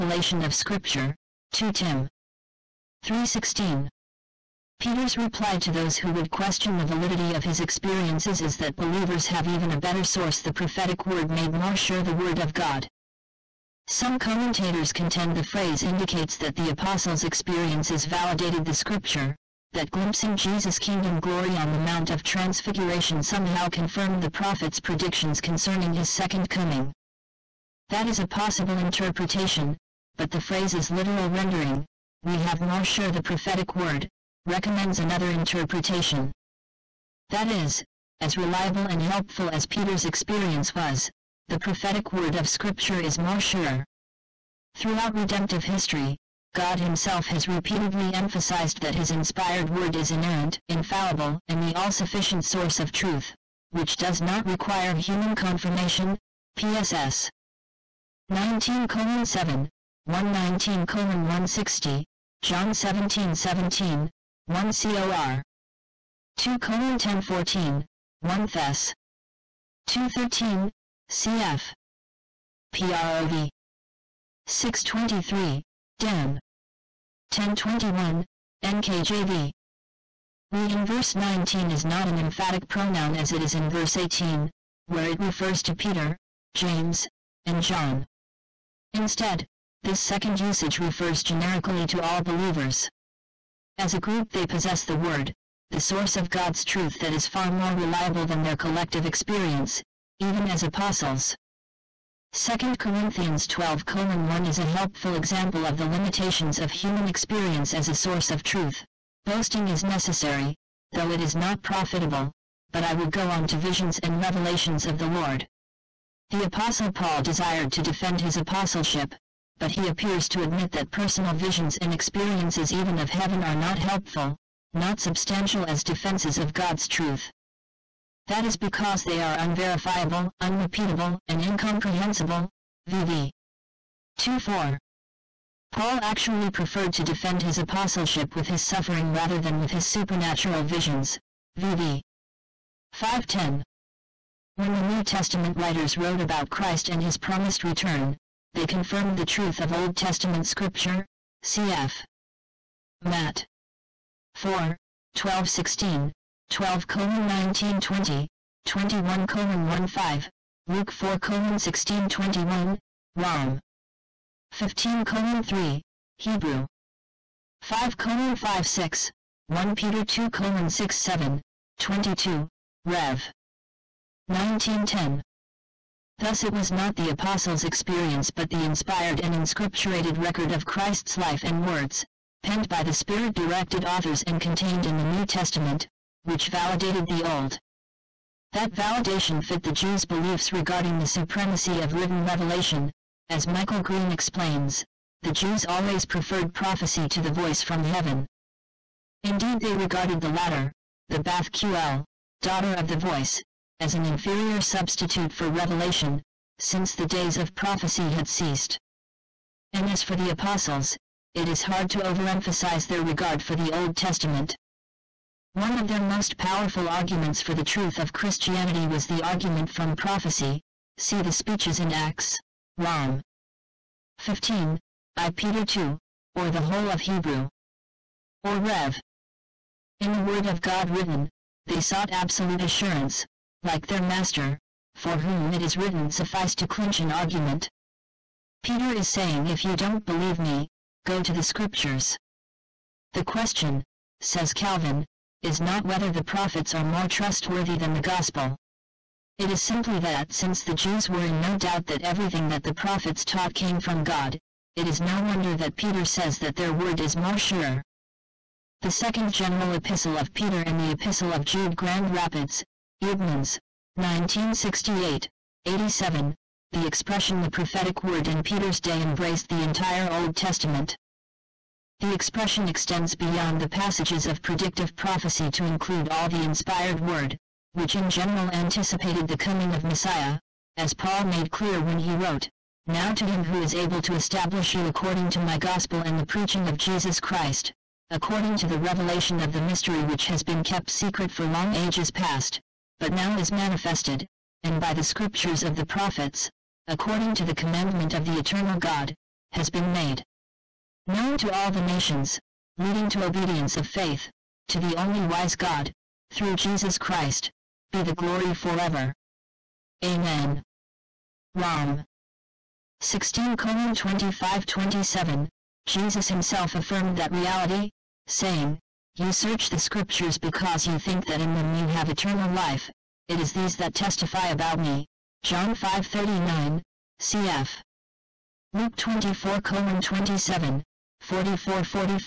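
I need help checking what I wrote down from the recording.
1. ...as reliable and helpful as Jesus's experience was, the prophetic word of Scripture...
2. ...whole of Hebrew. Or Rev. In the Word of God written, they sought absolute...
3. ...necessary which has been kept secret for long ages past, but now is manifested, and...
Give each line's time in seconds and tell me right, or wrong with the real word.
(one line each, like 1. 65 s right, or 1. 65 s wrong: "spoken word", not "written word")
1. 38 s wrong: "Peter", not "Jesus"
2. 226 s right
3. 289 s wrong: "mystery", not "necessary".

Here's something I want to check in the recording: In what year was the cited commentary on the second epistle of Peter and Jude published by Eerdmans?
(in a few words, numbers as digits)
1968.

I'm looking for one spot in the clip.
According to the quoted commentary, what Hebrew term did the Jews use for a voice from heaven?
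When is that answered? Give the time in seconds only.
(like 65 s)
201 s.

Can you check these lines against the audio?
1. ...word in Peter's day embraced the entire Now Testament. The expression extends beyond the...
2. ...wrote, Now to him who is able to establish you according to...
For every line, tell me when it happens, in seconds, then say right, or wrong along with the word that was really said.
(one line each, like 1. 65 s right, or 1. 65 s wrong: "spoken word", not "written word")
1. 268 s wrong: "Old", not "Now"
2. 282 s right.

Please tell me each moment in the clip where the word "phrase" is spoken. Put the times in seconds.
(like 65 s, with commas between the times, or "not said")
15 s, 30 s.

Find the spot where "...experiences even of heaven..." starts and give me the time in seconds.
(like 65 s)
121 s.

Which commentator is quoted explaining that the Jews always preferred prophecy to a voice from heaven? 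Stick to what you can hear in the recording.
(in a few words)
Michael Green.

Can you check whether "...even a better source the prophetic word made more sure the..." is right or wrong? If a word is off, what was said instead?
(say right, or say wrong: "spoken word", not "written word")
right.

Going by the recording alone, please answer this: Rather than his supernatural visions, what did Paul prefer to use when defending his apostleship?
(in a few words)
his suffering.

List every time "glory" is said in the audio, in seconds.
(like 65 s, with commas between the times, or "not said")
21 s, 308 s.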